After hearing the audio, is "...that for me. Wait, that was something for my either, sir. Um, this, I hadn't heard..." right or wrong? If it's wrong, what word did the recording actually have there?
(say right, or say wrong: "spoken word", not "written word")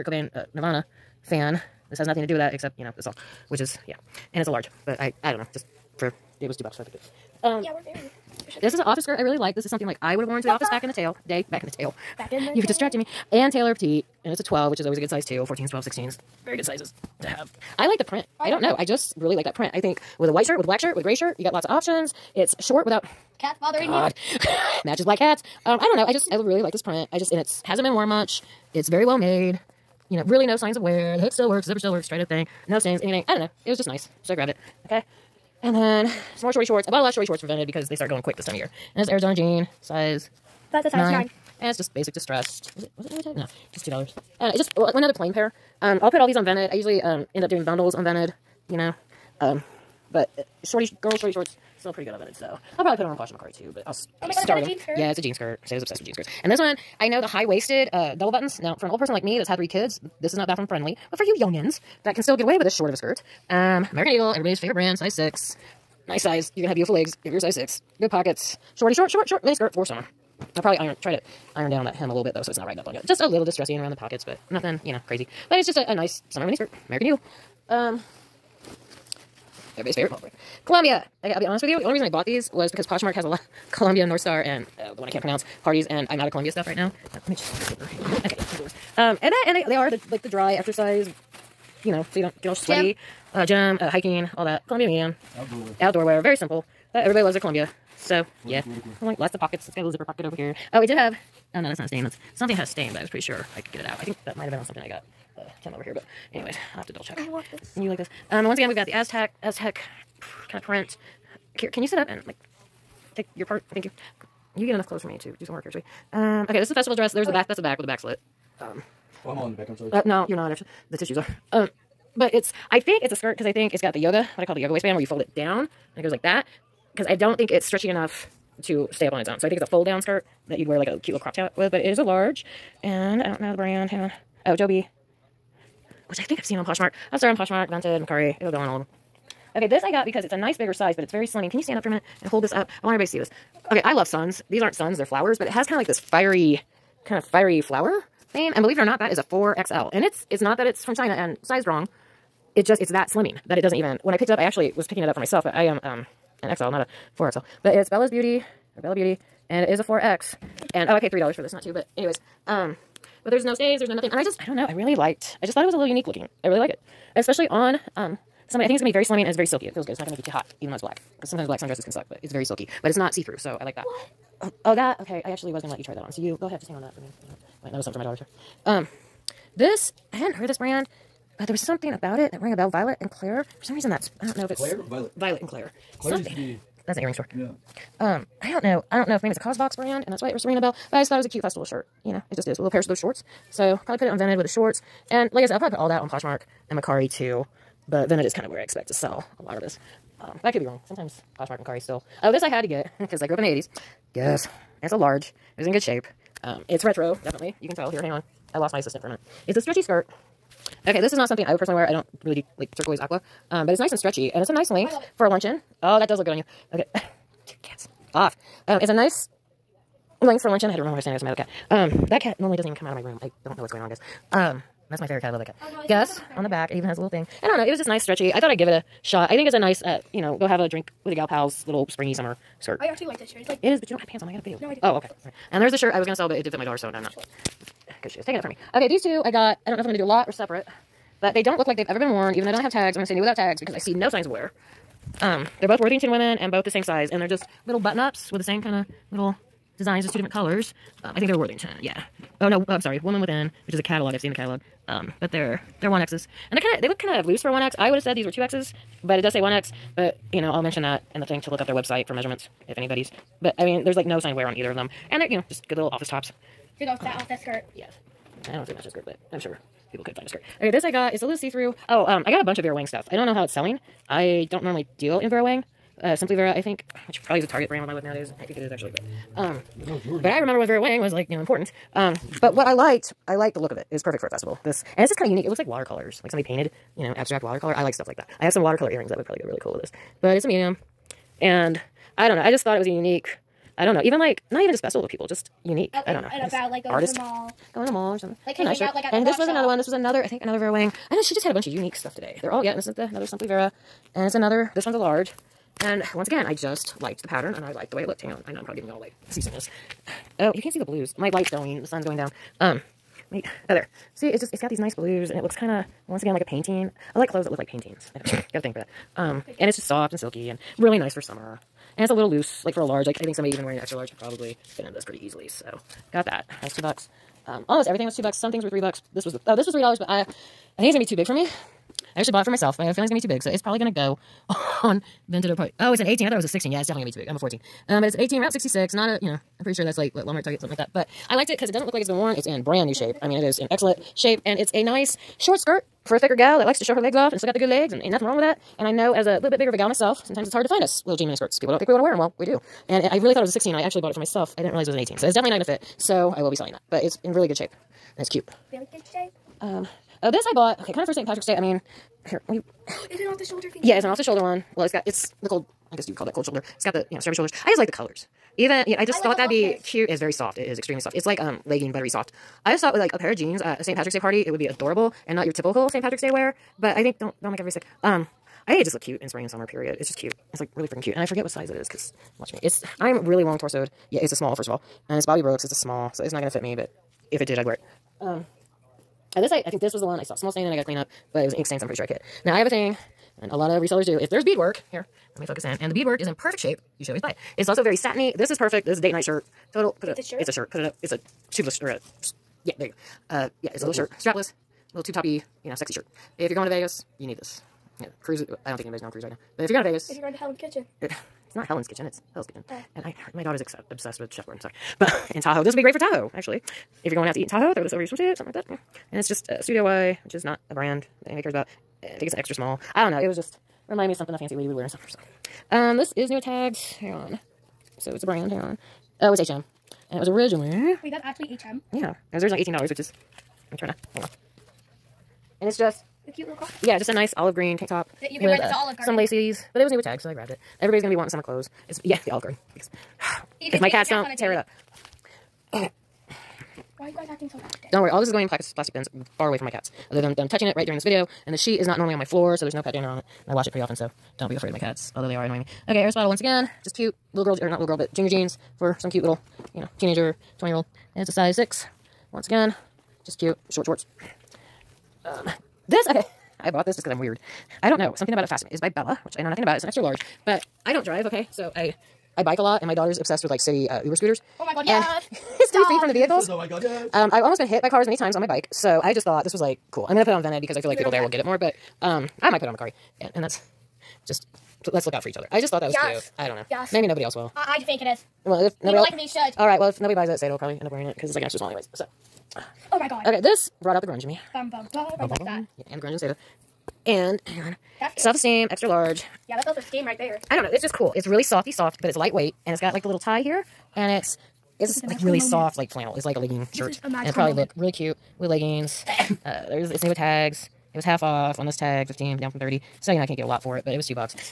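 wrong: "daughter", not "either".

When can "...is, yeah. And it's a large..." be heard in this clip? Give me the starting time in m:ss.
0:03.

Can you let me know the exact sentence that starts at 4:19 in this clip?
But, you know, I'll mention that in the thing to look up their website for measurements if anybody's.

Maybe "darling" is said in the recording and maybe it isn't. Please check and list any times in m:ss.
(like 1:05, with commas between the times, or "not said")
not said.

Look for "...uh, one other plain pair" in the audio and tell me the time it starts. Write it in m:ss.
0:44.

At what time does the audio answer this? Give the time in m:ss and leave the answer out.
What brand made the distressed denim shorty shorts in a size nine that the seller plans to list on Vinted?
0:39.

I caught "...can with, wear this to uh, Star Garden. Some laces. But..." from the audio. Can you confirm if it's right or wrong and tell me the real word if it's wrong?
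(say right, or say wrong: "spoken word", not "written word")
wrong: "Olive", not "Star".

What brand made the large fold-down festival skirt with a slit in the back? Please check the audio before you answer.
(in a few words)
Joby.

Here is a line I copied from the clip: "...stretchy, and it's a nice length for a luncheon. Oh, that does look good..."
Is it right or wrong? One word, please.
right.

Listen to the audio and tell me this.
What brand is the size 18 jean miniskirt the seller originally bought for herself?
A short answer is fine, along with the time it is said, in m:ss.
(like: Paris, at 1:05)
Route 66, at 5:38.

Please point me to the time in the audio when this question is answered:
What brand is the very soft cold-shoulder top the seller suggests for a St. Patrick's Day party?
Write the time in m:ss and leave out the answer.
6:25.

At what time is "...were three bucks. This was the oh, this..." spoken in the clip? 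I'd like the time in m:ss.
5:28.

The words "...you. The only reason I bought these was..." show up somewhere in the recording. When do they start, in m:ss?
1:21.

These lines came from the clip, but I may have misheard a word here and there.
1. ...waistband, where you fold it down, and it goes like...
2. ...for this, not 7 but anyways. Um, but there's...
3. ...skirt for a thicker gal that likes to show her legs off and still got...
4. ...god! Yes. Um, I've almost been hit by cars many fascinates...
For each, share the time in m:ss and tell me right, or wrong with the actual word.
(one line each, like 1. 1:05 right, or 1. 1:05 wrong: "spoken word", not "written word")
1. 2:04 right
2. 2:41 wrong: "2", not "7"
3. 5:45 right
4. 7:56 wrong: "times", not "fascinates".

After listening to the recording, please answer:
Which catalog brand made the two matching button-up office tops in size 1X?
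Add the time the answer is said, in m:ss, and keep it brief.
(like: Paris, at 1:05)
Woman Within, at 4:13.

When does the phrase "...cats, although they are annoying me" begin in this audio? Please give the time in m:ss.
7:34.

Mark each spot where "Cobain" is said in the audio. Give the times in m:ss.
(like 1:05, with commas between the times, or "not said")
0:00.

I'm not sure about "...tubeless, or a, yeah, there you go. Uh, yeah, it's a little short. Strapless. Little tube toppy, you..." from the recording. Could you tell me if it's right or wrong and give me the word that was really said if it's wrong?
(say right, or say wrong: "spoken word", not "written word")
wrong: "shirt", not "short".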